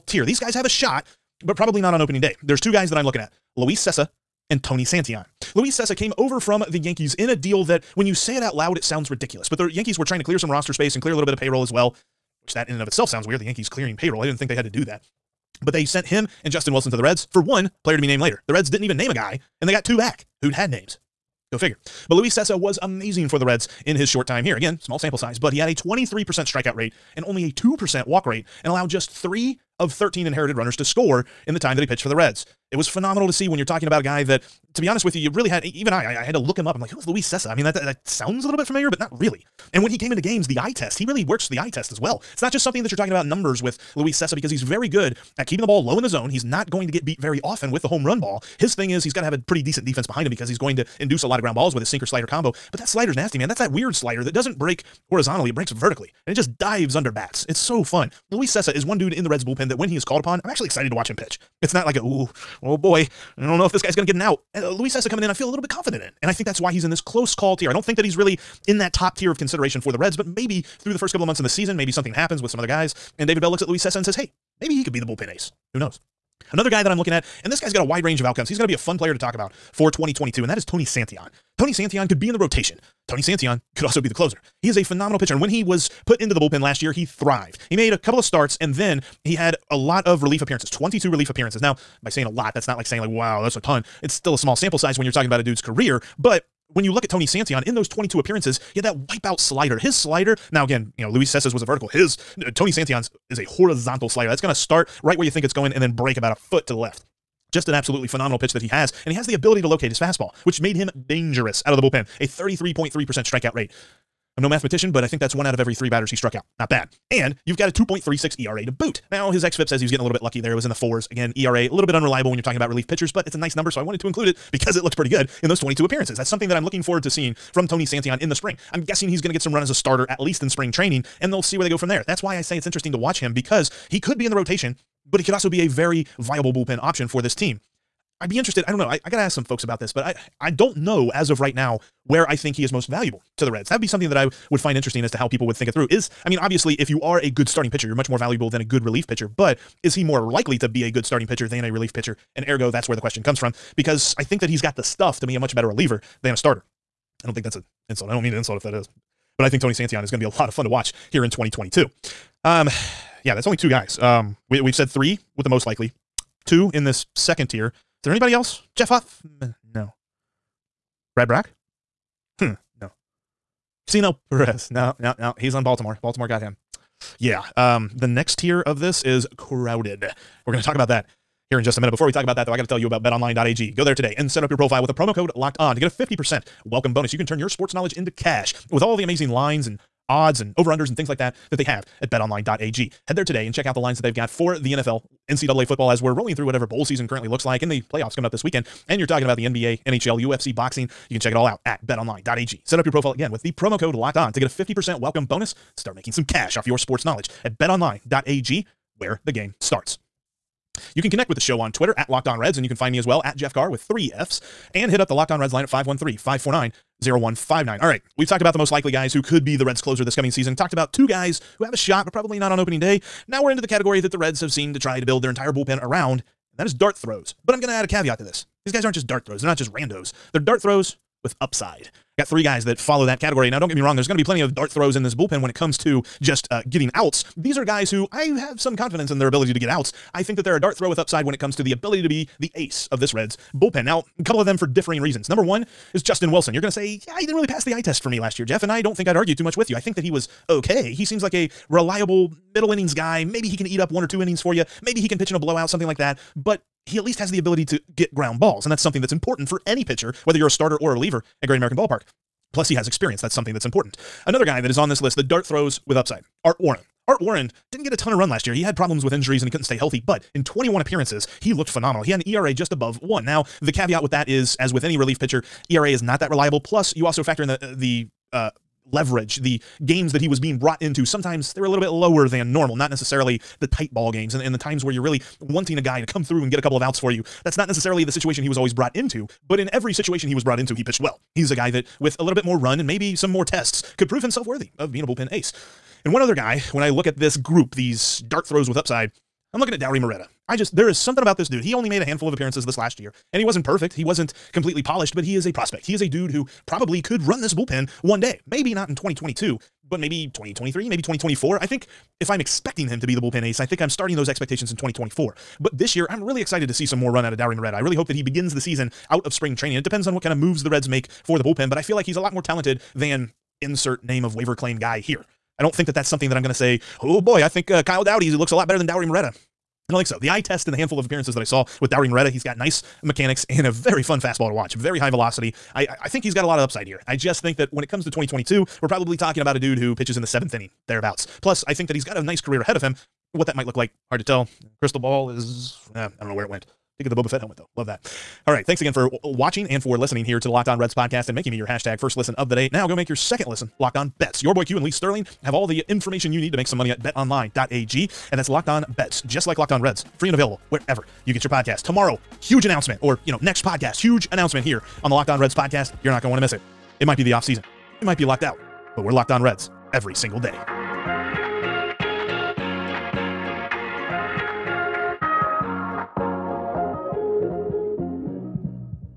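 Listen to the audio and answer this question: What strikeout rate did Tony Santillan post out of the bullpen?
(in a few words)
33.3%.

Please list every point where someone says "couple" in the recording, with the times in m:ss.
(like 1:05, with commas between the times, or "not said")
1:11, 1:27, 4:04, 4:46.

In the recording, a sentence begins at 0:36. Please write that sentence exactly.
I'm like, who is Luis Cessa?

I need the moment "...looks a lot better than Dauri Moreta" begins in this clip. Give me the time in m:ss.
5:28.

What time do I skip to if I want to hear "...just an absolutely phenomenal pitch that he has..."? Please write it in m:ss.
1:47.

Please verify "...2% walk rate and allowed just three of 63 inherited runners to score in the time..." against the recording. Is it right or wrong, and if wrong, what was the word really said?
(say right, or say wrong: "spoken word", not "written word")
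wrong: "13", not "63".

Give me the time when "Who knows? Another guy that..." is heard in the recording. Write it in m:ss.
1:15.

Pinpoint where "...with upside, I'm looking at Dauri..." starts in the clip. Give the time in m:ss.
4:58.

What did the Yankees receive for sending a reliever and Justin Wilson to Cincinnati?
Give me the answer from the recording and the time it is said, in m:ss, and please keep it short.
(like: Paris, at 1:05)
one player to be named later, at 0:17.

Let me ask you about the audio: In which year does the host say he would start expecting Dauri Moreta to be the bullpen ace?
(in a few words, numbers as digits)
2024.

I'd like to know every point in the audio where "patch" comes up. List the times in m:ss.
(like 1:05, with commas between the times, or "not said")
not said.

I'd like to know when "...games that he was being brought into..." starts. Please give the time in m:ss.
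4:39.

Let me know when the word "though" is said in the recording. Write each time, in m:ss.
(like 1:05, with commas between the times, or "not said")
3:02, 5:47.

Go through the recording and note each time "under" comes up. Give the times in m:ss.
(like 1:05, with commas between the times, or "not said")
0:56, 3:10.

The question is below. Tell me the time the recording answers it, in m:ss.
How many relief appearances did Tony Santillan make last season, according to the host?
1:30.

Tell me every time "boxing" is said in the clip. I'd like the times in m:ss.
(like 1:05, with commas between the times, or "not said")
3:20.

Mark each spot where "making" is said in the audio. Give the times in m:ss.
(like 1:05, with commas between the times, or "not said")
3:25, 5:51.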